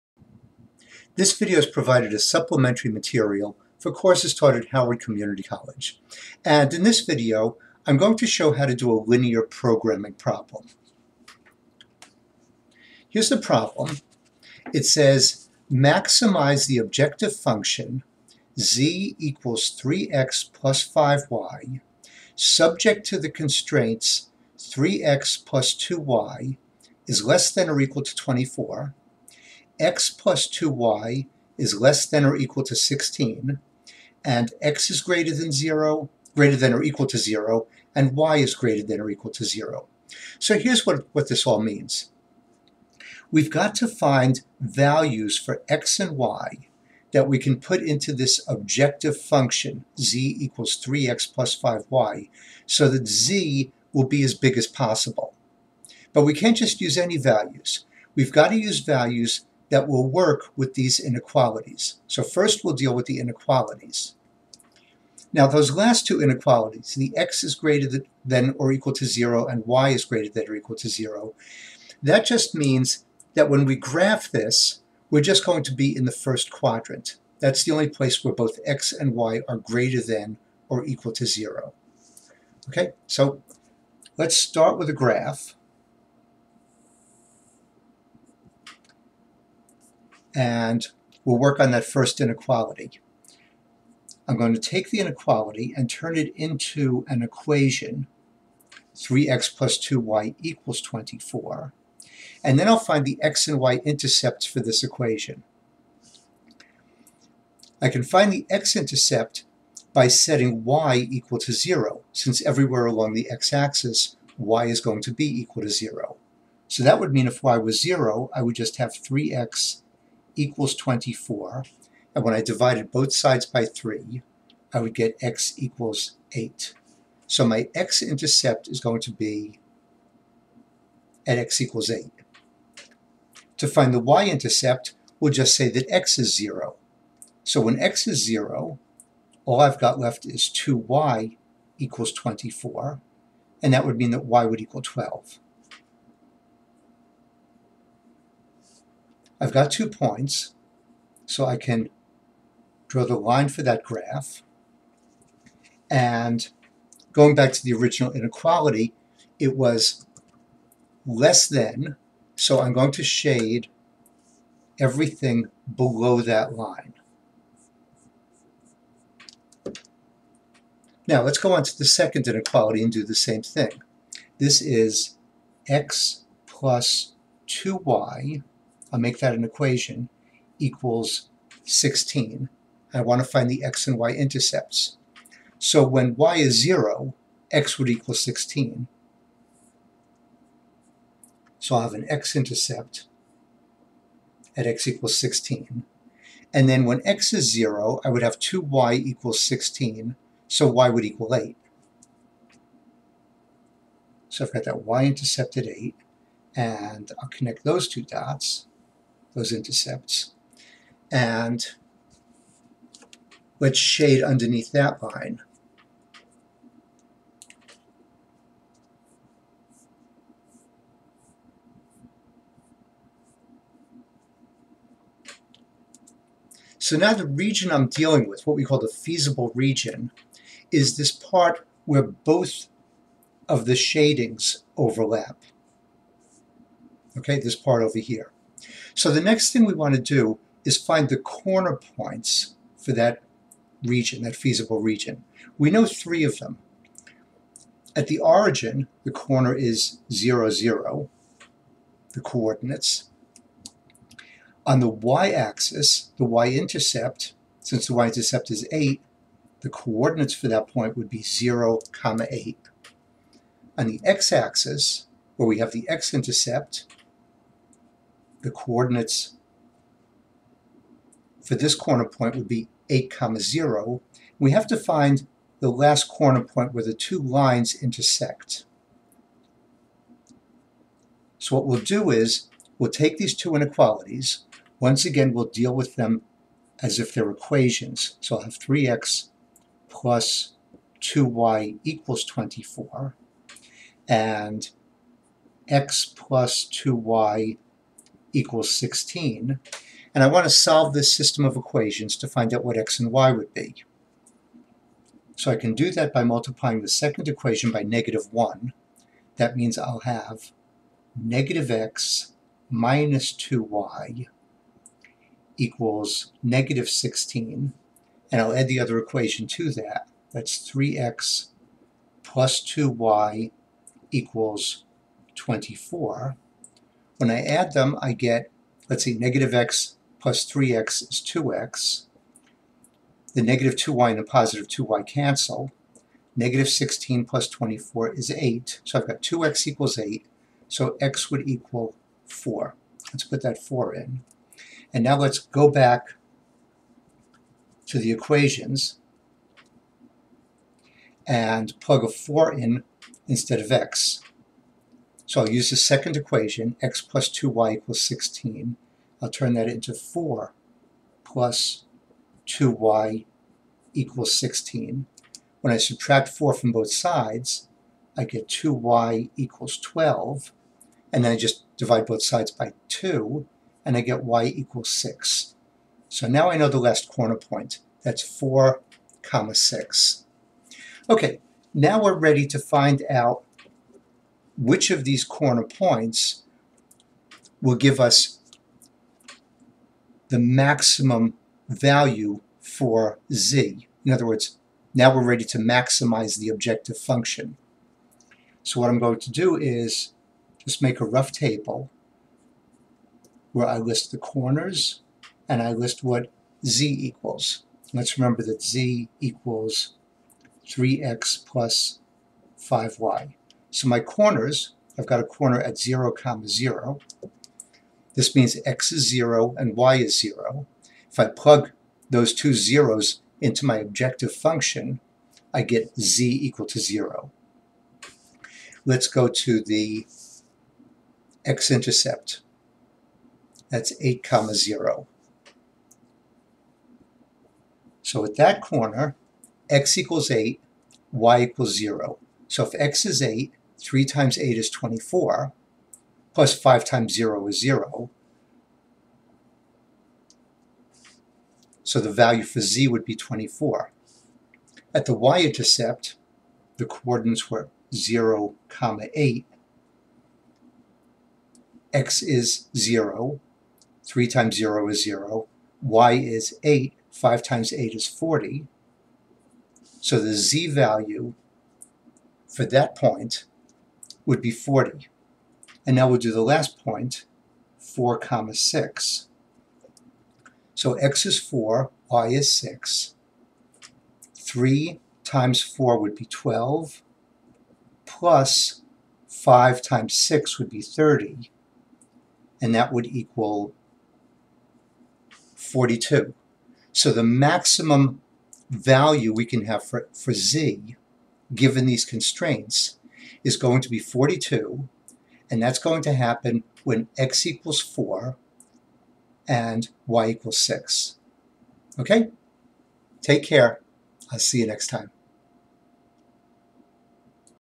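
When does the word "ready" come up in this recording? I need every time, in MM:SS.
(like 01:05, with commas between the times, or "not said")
06:22, 06:35.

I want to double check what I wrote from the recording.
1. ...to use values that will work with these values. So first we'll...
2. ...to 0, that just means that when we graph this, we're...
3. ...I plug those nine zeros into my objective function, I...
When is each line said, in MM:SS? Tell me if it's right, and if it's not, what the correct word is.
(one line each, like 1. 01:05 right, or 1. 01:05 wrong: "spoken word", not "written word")
1. 00:58 wrong: "inequalities", not "values"
2. 01:10 right
3. 07:01 wrong: "two", not "nine".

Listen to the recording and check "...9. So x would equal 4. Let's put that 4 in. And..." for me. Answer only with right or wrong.
wrong.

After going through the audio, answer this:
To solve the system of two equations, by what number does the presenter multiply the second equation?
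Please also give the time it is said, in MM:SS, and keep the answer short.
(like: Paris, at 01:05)
-1, at 05:07.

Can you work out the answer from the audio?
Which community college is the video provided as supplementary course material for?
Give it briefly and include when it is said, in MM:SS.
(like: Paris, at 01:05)
Howard Community College, at 00:04.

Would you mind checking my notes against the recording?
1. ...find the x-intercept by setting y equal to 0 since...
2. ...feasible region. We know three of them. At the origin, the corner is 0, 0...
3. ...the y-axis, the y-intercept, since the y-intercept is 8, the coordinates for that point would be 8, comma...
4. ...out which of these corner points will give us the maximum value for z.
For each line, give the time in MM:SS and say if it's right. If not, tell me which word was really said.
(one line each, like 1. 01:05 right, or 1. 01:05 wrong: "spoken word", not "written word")
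1. 01:48 right
2. 04:04 right
3. 04:14 wrong: "0", not "8"
4. 06:23 right.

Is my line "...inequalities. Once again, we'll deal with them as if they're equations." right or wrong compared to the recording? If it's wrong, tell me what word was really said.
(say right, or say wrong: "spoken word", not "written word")
right.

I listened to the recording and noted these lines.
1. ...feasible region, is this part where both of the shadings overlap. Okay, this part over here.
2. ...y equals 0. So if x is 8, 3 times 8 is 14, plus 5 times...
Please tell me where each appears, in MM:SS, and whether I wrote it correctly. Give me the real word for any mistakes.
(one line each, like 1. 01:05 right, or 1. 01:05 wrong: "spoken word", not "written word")
1. 03:48 right
2. 07:21 wrong: "24", not "14".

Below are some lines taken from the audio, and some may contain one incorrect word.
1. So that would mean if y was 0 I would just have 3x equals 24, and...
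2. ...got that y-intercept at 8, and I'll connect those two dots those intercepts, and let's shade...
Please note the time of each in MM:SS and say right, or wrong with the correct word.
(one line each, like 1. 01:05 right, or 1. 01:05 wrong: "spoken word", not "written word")
1. 01:56 right
2. 03:24 right.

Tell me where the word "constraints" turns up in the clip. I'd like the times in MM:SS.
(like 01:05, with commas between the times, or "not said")
00:23, 08:22.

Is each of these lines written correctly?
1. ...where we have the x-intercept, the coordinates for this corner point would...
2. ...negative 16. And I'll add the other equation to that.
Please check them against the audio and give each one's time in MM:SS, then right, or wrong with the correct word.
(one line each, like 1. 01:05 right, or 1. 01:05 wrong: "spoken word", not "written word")
1. 04:25 right
2. 05:16 right.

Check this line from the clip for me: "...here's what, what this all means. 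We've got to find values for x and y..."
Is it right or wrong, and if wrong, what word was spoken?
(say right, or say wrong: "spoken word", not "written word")
right.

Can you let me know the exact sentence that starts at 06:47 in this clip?
Let's remember that z equals 3x plus 5y.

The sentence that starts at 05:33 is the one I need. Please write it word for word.
The negative 2y and the positive 2y cancel.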